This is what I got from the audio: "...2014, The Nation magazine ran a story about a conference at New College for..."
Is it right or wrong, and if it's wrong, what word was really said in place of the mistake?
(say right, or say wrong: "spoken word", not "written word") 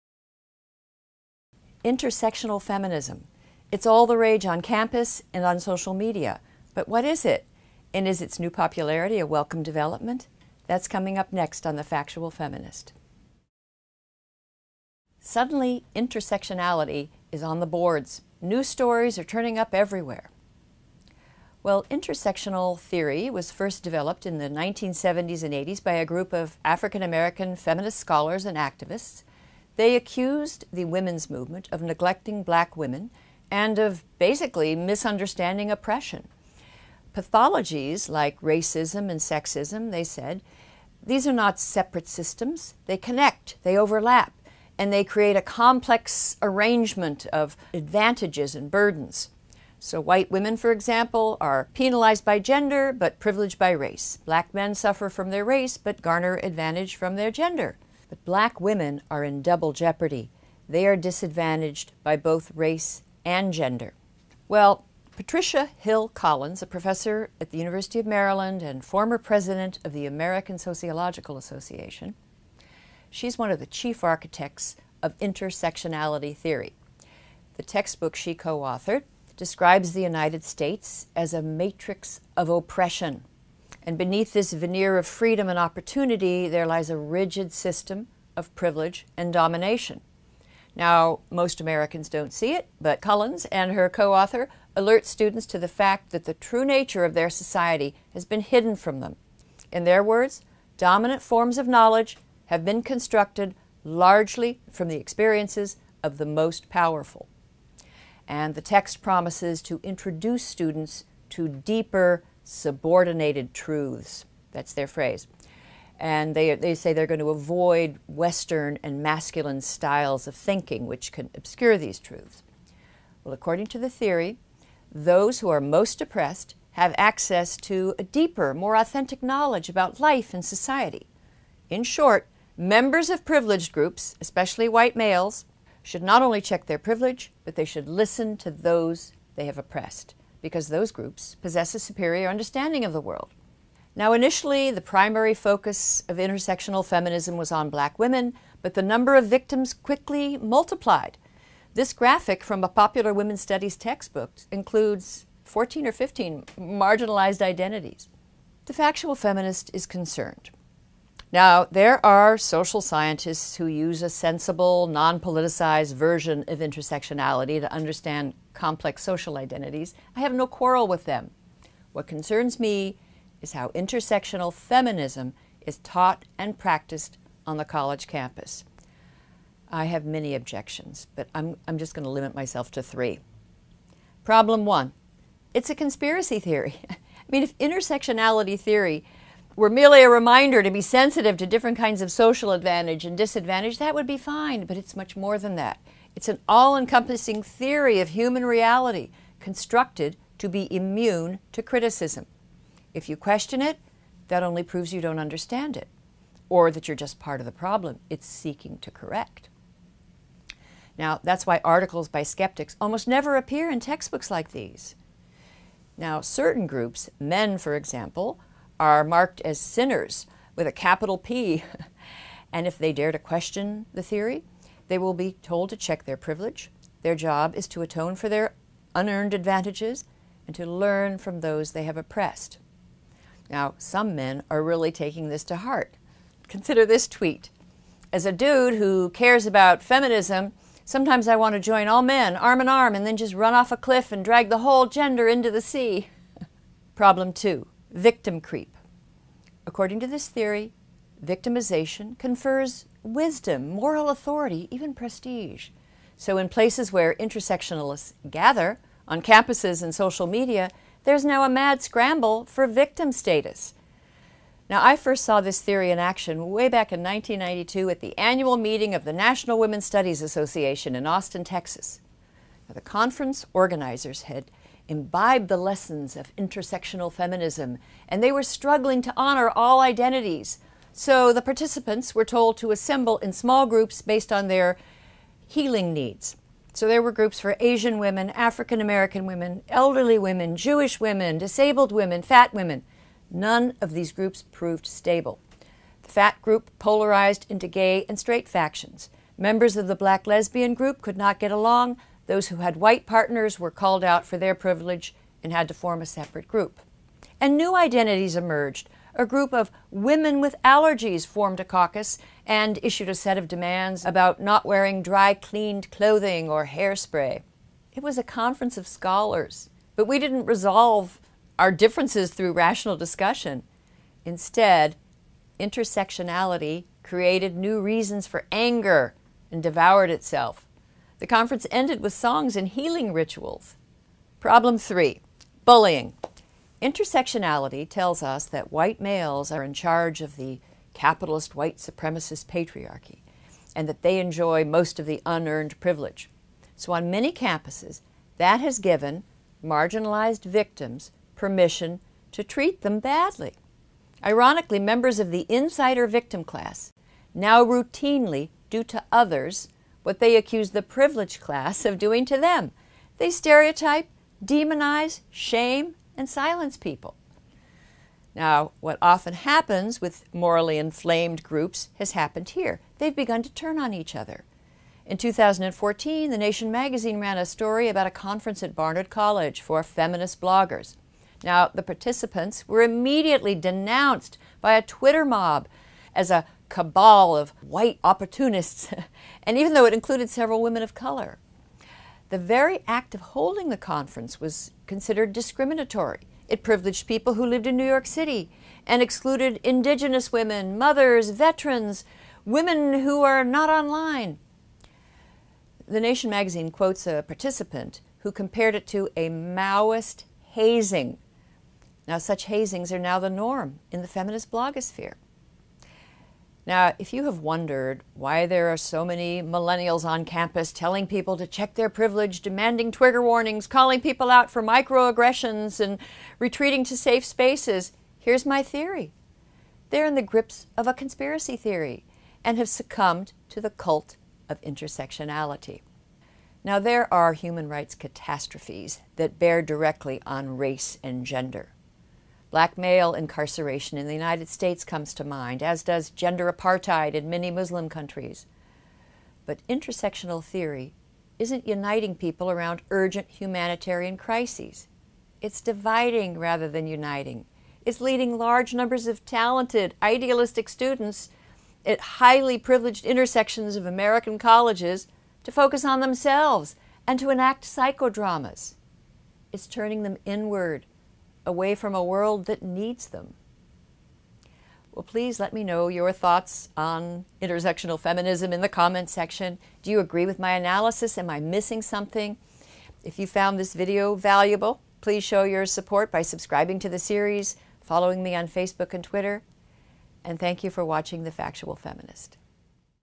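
wrong: "Barnard", not "New".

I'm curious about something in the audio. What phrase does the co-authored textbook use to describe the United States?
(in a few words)
matrix of oppression.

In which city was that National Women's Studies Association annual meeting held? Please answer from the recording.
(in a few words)
Austin, Texas.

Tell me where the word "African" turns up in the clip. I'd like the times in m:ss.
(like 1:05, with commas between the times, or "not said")
0:26, 4:48.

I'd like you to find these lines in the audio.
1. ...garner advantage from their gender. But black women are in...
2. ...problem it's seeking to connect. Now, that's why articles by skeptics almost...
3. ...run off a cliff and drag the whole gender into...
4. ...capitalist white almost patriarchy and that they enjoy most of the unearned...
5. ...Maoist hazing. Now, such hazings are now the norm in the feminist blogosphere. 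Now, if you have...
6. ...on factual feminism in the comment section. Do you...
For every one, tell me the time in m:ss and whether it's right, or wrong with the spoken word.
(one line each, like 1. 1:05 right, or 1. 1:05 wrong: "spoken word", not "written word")
1. 0:56 right
2. 3:27 wrong: "correct", not "connect"
3. 4:03 right
4. 5:40 wrong: "supremacist", not "almost"
5. 6:49 right
6. 7:56 wrong: "intersectional", not "factual".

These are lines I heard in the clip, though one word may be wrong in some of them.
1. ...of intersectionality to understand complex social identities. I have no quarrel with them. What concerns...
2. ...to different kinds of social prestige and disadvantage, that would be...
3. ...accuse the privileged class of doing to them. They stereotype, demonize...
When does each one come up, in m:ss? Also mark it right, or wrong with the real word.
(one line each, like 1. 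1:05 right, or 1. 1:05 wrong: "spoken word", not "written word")
1. 2:46 right
2. 3:11 wrong: "advantage", not "prestige"
3. 6:00 right.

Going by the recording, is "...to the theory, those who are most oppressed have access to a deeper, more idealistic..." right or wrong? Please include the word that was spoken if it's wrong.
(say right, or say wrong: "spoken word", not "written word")
wrong: "authentic", not "idealistic".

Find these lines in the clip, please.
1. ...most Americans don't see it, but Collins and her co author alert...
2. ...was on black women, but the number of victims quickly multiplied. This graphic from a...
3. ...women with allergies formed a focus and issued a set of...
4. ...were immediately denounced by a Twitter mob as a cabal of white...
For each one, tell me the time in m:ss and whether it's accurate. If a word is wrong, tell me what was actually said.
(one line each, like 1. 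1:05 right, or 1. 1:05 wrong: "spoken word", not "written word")
1. 1:31 right
2. 2:27 right
3. 5:09 wrong: "caucus", not "focus"
4. 6:22 right.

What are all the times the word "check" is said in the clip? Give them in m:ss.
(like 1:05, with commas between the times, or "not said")
2:16, 3:45, 7:01.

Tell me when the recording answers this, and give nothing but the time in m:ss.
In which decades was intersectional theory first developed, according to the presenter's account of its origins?
0:24.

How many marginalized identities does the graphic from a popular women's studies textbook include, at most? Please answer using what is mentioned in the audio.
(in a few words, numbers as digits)
15.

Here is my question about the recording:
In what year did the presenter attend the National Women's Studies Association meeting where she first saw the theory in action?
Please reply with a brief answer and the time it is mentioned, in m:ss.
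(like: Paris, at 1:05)
1992, at 4:27.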